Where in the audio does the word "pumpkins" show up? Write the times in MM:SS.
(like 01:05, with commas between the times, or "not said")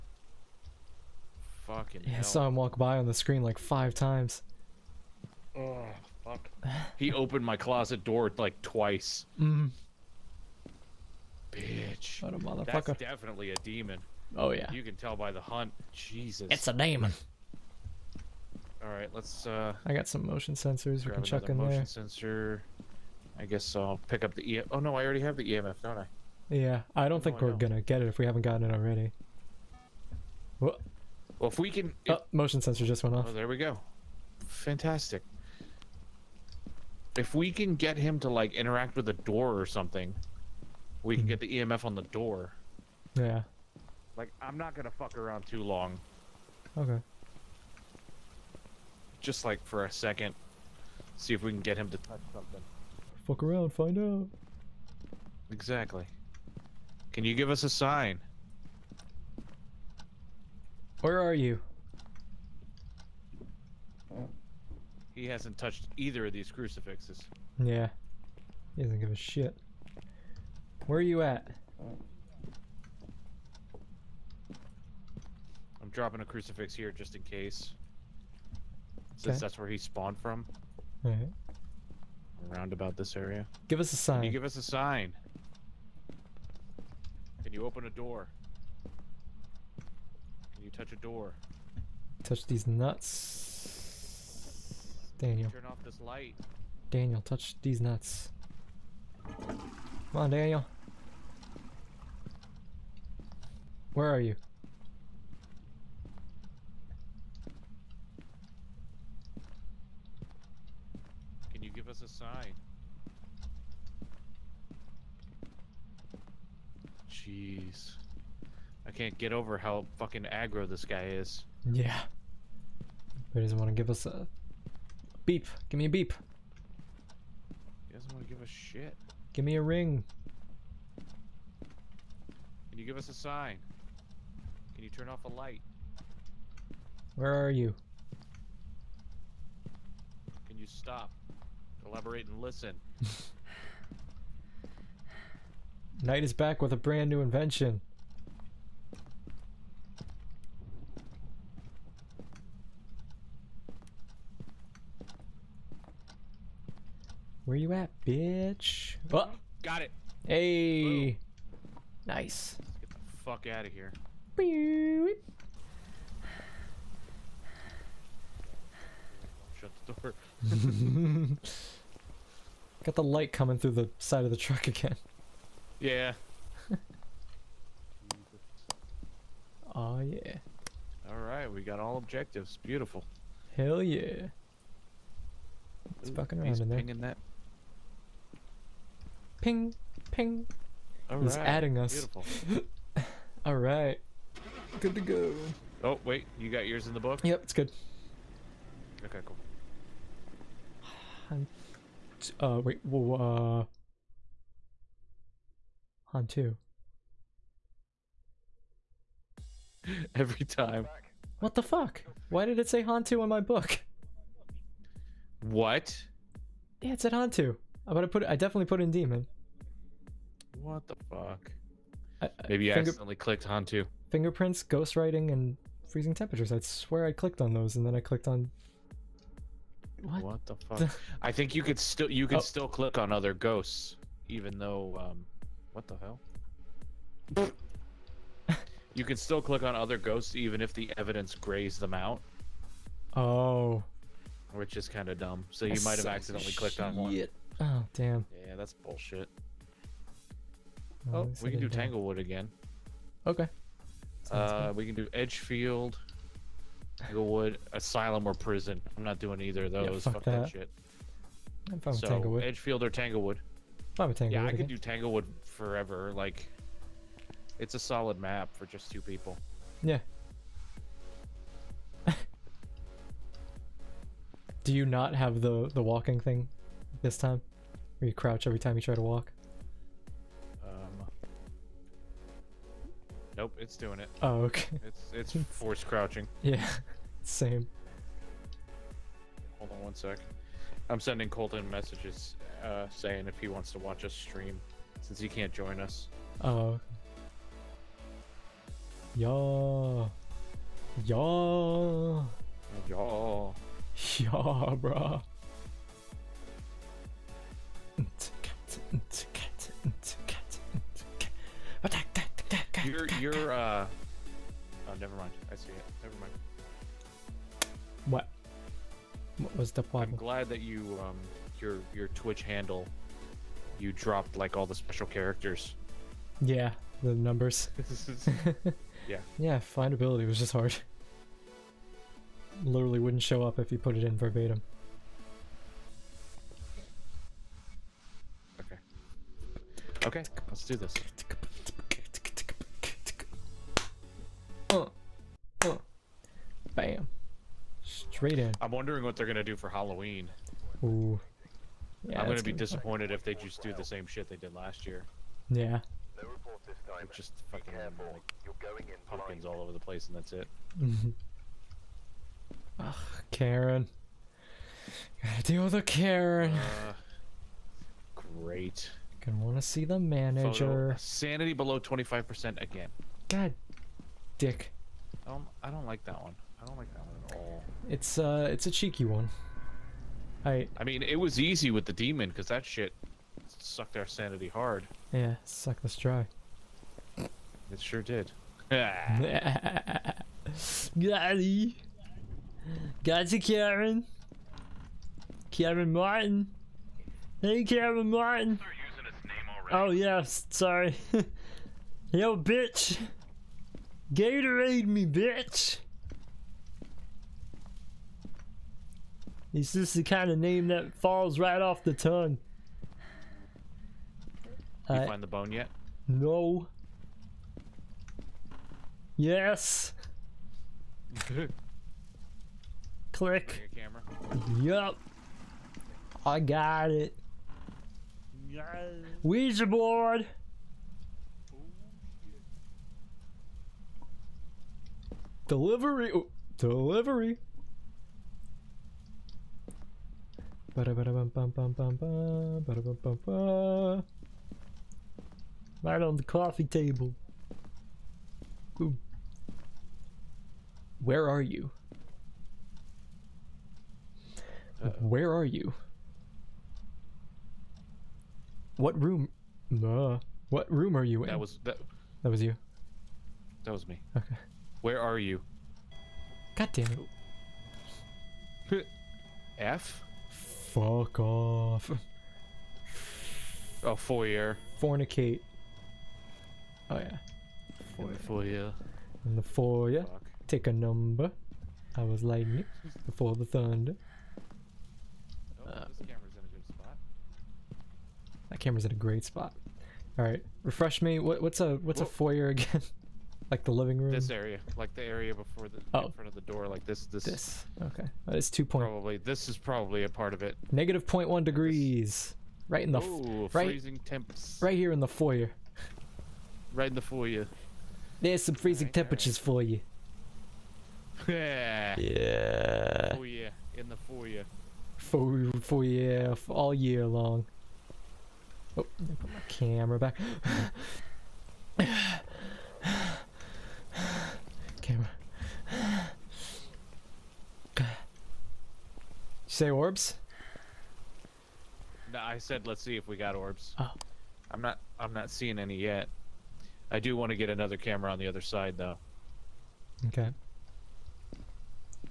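05:59.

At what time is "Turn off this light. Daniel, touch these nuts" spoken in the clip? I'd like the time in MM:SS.
01:35.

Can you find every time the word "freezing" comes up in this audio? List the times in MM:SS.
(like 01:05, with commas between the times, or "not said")
03:45, 08:23, 08:28.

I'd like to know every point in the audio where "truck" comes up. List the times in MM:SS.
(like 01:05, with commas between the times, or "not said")
02:54.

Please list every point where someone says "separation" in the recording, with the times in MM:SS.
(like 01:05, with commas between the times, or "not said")
not said.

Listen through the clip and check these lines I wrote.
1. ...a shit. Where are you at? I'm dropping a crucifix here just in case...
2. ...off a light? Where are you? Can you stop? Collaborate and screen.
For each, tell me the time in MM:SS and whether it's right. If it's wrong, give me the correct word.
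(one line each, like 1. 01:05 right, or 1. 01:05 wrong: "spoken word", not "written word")
1. 01:09 right
2. 02:15 wrong: "listen", not "screen".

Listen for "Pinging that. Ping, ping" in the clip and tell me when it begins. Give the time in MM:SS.
03:06.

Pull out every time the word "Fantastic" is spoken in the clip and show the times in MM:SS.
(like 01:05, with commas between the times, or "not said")
00:34.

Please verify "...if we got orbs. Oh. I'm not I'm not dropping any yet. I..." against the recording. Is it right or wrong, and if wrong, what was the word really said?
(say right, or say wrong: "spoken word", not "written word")
wrong: "seeing", not "dropping".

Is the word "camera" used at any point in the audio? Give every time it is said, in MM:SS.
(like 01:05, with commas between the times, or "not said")
08:06, 08:39, 08:44, 08:57.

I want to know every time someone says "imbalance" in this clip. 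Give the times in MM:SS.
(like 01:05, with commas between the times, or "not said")
not said.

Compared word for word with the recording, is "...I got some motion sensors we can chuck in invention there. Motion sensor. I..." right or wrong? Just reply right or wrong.
wrong.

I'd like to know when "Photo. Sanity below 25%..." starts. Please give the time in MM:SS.
06:10.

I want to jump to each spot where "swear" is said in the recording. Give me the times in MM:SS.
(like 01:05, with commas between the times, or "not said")
03:46.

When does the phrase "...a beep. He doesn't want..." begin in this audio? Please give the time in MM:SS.
02:05.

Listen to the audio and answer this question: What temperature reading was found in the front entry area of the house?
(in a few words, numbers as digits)
-0.1 degrees.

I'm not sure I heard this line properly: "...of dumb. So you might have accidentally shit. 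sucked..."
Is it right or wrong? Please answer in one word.
wrong.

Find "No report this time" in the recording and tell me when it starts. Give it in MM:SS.
05:56.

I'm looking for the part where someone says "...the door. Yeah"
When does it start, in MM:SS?
00:41.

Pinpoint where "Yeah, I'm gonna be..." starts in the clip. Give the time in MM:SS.
05:52.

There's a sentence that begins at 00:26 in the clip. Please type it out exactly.
Yeah, I don't think we're don't.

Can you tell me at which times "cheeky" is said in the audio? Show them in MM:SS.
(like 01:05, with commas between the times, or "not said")
06:18.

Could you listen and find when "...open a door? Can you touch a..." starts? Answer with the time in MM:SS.
01:27.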